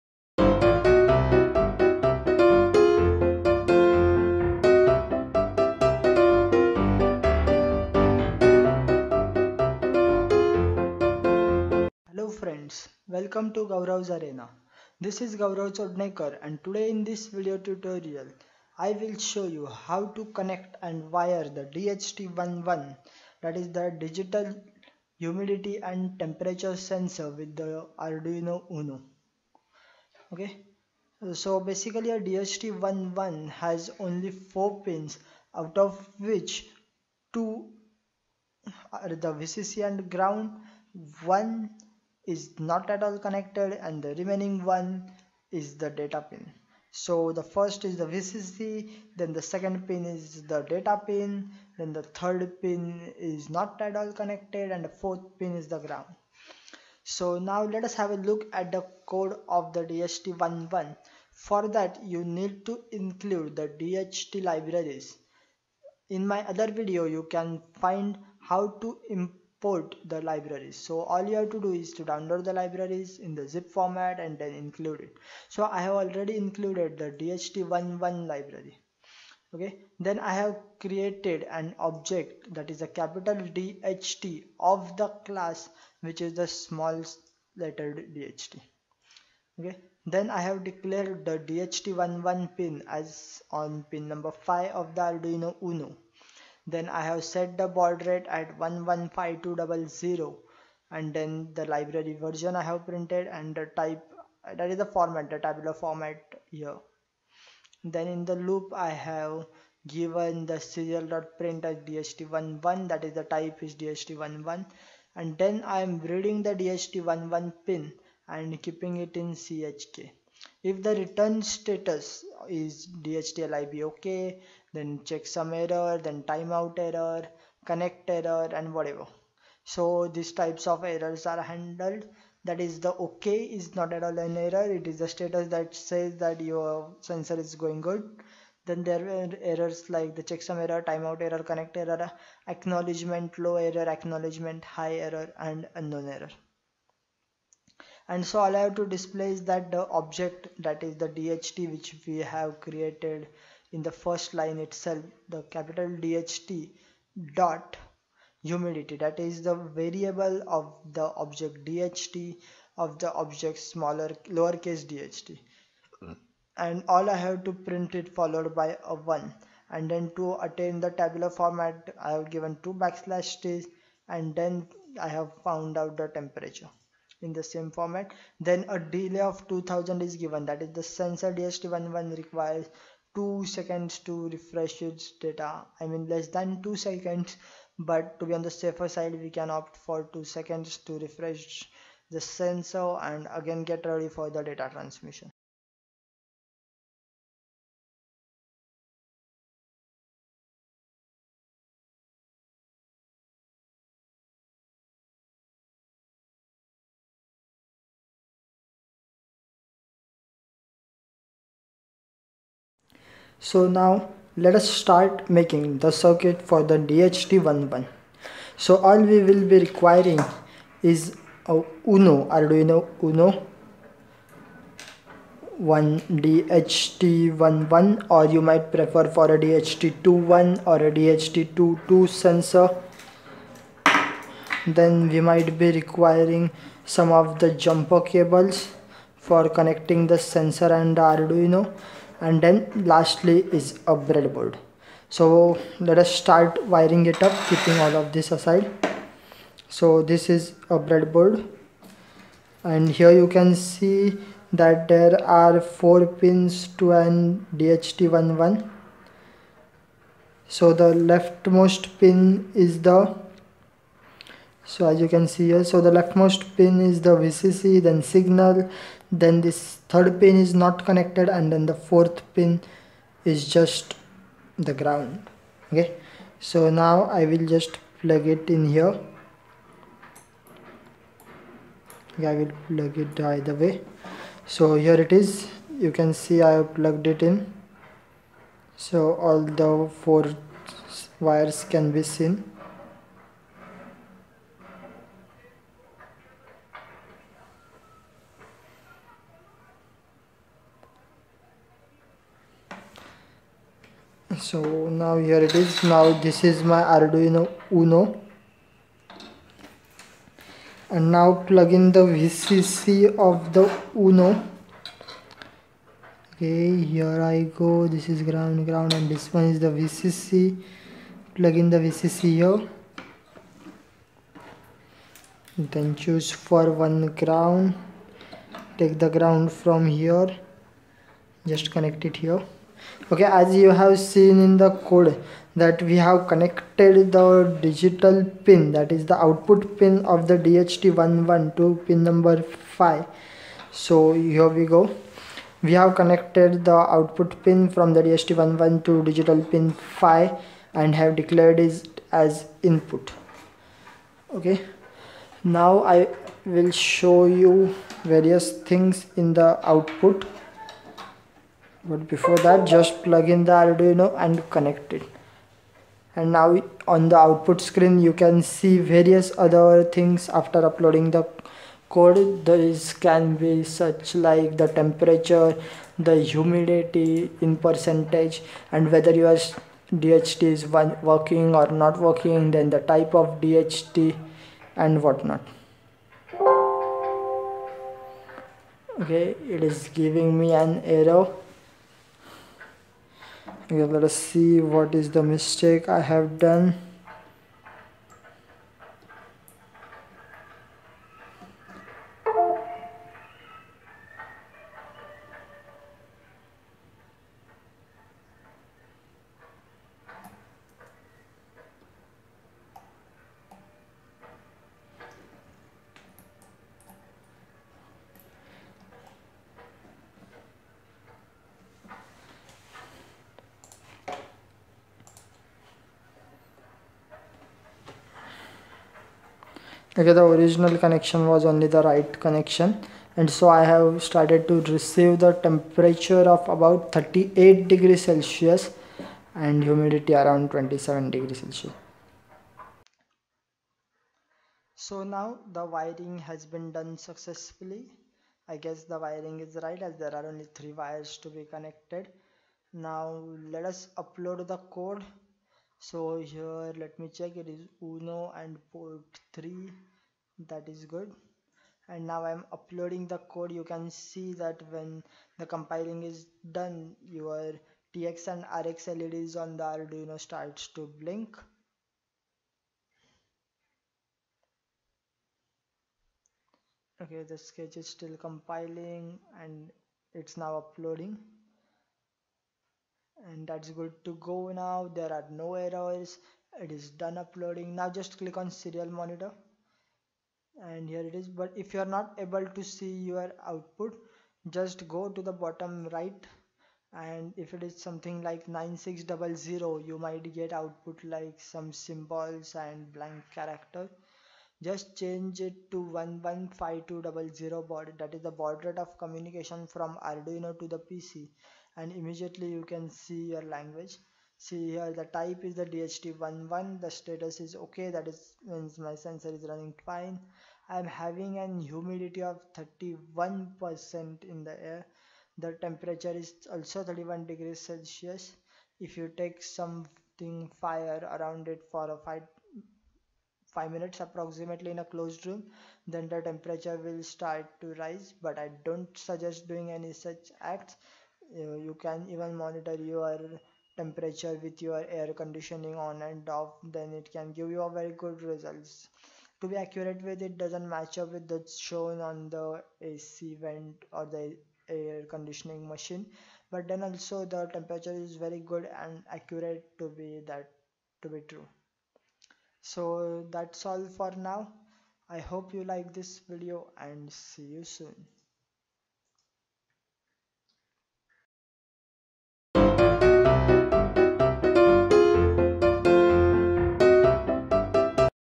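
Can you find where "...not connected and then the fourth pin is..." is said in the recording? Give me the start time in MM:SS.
04:30.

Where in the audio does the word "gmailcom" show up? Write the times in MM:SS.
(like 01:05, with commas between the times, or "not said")
not said.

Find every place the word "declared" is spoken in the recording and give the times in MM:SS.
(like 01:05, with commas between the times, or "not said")
01:30, 05:51.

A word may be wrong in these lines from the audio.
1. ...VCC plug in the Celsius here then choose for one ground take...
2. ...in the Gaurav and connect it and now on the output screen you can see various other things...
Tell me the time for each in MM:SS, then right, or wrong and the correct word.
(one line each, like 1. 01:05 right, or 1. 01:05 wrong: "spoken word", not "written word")
1. 05:19 wrong: "VCC", not "Celsius"
2. 06:03 wrong: "Arduino", not "Gaurav".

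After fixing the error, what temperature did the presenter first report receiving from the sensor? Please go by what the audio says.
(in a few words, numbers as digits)
38 degrees Celsius.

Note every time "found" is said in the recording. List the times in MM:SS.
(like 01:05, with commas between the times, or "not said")
02:55.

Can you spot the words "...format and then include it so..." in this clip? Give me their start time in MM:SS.
01:13.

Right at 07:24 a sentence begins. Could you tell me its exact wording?
So now the wiring has been done successfully.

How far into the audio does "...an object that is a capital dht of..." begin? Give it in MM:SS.
01:21.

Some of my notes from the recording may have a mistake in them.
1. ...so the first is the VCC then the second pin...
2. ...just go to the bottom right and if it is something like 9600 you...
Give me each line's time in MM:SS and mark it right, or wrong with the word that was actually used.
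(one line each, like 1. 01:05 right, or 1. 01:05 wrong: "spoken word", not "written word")
1. 00:46 right
2. 08:14 right.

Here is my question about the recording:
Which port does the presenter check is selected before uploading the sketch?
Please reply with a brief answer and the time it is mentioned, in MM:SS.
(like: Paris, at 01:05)
Port 3, at 07:38.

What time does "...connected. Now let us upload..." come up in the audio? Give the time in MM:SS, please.
07:31.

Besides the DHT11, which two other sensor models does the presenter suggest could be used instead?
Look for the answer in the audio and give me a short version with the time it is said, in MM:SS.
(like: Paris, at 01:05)
DHT21 or DHT22, at 03:49.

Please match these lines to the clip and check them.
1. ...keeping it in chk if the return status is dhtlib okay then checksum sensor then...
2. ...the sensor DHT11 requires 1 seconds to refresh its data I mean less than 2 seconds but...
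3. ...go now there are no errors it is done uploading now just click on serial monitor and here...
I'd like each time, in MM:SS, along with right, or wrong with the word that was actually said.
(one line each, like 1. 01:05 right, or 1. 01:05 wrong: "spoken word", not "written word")
1. 01:58 wrong: "error", not "sensor"
2. 03:00 wrong: "2", not "1"
3. 08:04 right.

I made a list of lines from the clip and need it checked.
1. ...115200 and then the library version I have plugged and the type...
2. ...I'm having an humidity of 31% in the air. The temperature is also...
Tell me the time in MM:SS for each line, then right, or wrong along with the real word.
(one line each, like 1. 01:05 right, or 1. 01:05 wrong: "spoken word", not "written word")
1. 01:38 wrong: "printed", not "plugged"
2. 08:40 right.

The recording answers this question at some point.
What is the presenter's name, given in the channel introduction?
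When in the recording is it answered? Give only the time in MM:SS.
00:15.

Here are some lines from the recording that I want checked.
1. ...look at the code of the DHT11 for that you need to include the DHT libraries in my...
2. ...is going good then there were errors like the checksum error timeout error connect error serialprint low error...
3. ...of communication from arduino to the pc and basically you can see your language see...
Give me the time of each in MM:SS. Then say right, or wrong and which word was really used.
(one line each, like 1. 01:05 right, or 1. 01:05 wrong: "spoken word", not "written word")
1. 00:58 right
2. 02:17 wrong: "acknowledgement", not "serialprint"
3. 08:28 wrong: "immediately", not "basically".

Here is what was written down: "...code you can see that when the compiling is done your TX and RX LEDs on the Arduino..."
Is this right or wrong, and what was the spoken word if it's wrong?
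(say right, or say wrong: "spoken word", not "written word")
right.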